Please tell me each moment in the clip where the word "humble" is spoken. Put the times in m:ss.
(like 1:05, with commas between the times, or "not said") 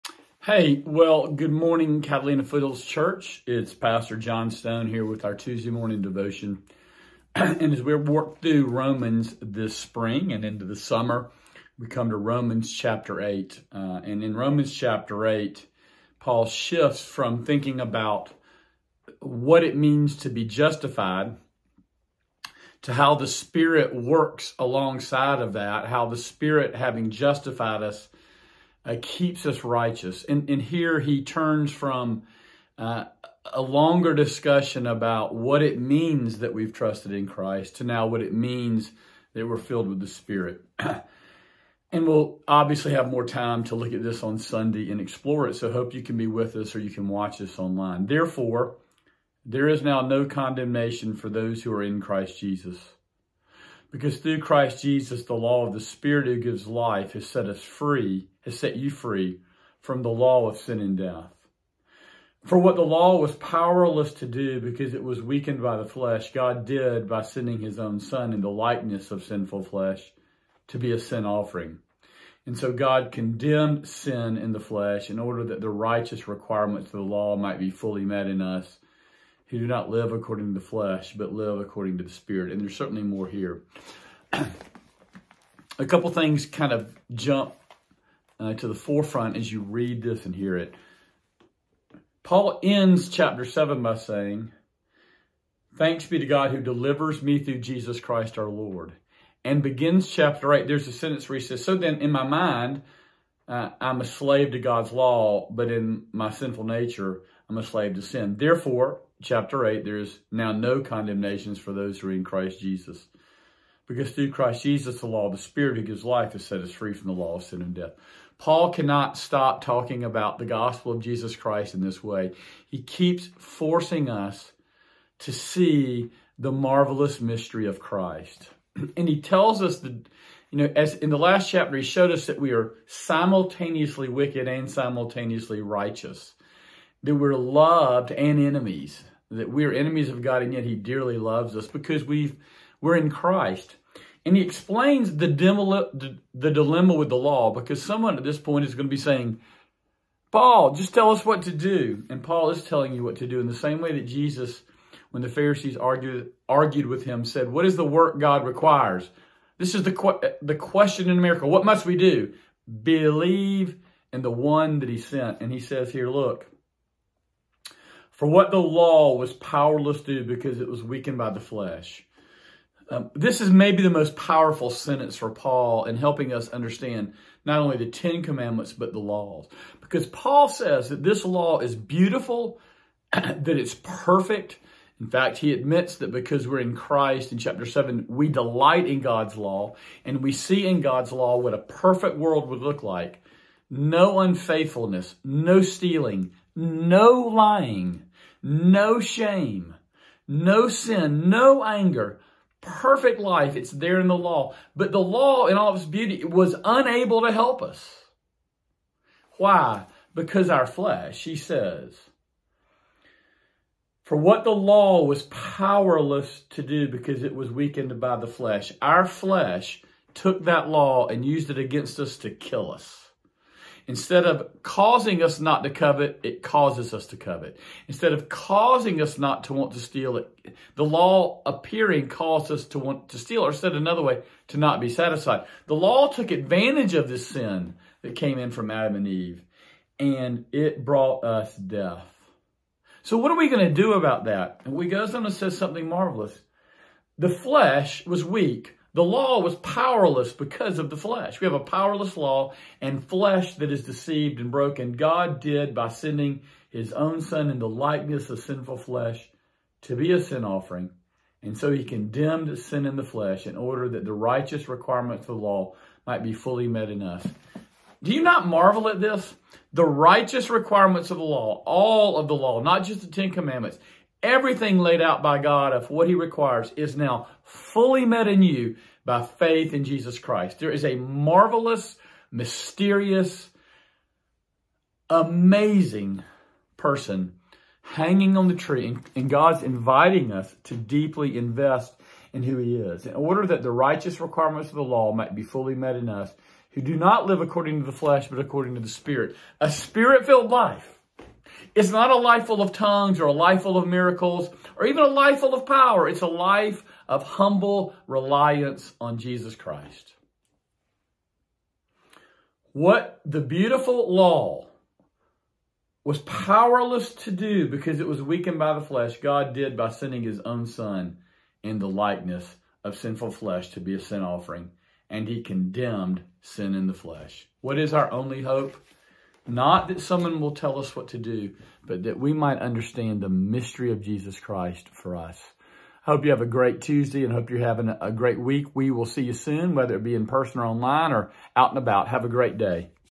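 5:07.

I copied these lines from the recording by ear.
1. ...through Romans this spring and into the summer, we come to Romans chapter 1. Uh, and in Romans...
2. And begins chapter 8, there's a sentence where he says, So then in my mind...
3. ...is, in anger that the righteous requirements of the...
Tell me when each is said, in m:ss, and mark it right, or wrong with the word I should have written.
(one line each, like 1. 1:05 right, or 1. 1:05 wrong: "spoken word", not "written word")
1. 0:08 wrong: "8", not "1"
2. 1:39 right
3. 4:52 wrong: "order", not "anger".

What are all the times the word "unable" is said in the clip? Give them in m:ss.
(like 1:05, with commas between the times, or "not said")
3:26.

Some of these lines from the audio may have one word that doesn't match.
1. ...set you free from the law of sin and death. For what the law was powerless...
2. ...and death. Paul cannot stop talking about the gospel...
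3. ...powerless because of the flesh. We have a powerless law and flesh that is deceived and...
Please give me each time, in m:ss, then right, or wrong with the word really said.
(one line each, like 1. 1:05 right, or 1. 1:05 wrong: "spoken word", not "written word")
1. 0:58 right
2. 1:57 right
3. 4:09 right.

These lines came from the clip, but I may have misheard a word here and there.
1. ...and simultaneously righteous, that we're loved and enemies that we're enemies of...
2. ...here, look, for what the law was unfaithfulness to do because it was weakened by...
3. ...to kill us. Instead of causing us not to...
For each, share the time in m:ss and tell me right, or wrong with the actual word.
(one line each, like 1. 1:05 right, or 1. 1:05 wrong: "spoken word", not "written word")
1. 2:14 right
2. 2:45 wrong: "powerless", not "unfaithfulness"
3. 3:42 right.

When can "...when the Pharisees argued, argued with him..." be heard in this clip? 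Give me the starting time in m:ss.
2:35.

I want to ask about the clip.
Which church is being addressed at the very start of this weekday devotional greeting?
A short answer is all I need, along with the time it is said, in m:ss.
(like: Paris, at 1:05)
Catalina Foothills Church, at 0:02.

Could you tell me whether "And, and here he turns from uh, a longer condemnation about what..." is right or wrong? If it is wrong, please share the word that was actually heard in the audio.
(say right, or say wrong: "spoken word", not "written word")
wrong: "discussion", not "condemnation".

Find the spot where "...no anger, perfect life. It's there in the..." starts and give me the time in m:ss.
3:21.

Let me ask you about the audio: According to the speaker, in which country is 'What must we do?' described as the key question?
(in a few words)
America.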